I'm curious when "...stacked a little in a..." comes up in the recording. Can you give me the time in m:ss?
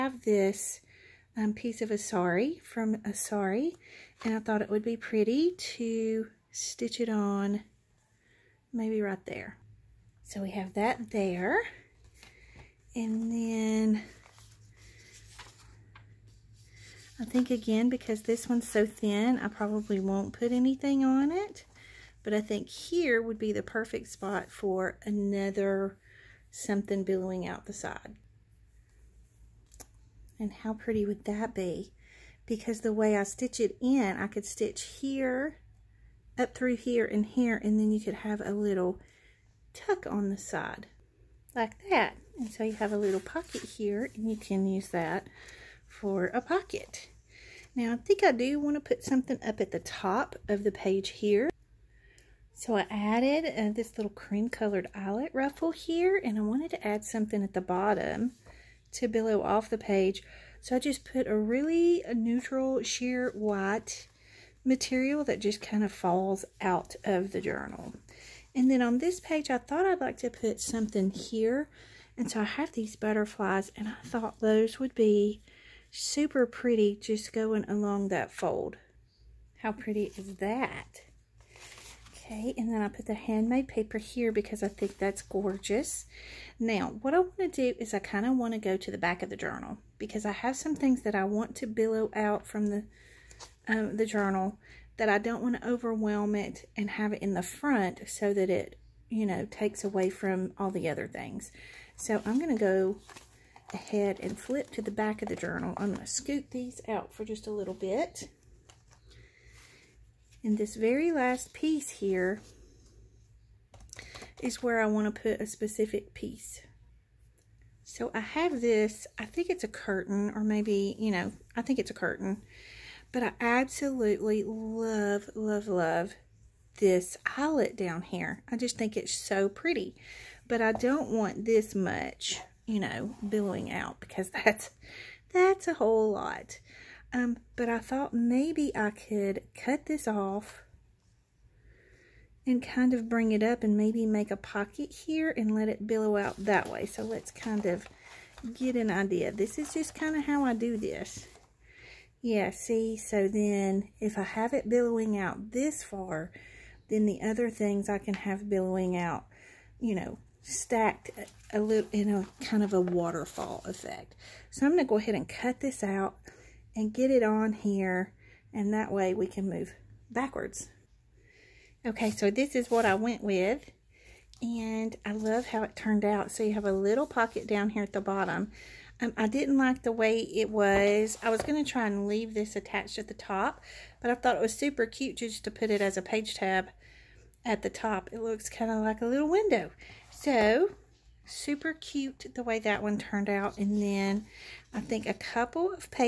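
2:40.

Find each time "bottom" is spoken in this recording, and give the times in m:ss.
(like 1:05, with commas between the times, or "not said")
0:57, 2:58.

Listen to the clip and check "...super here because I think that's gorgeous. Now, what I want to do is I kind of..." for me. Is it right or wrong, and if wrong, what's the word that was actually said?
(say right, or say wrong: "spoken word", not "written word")
wrong: "paper", not "super".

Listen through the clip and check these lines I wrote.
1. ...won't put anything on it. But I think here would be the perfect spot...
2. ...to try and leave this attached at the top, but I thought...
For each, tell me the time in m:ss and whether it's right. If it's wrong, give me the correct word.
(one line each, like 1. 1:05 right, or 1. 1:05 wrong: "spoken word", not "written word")
1. 0:19 right
2. 3:01 right.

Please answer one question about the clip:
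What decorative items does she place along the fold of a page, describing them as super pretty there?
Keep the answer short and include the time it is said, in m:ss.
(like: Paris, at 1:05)
Butterflies, at 1:12.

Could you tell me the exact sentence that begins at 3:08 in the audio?
It looks kind of like a little window.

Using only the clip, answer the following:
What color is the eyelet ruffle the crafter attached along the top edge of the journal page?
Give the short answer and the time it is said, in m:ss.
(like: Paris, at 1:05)
Cream, at 0:54.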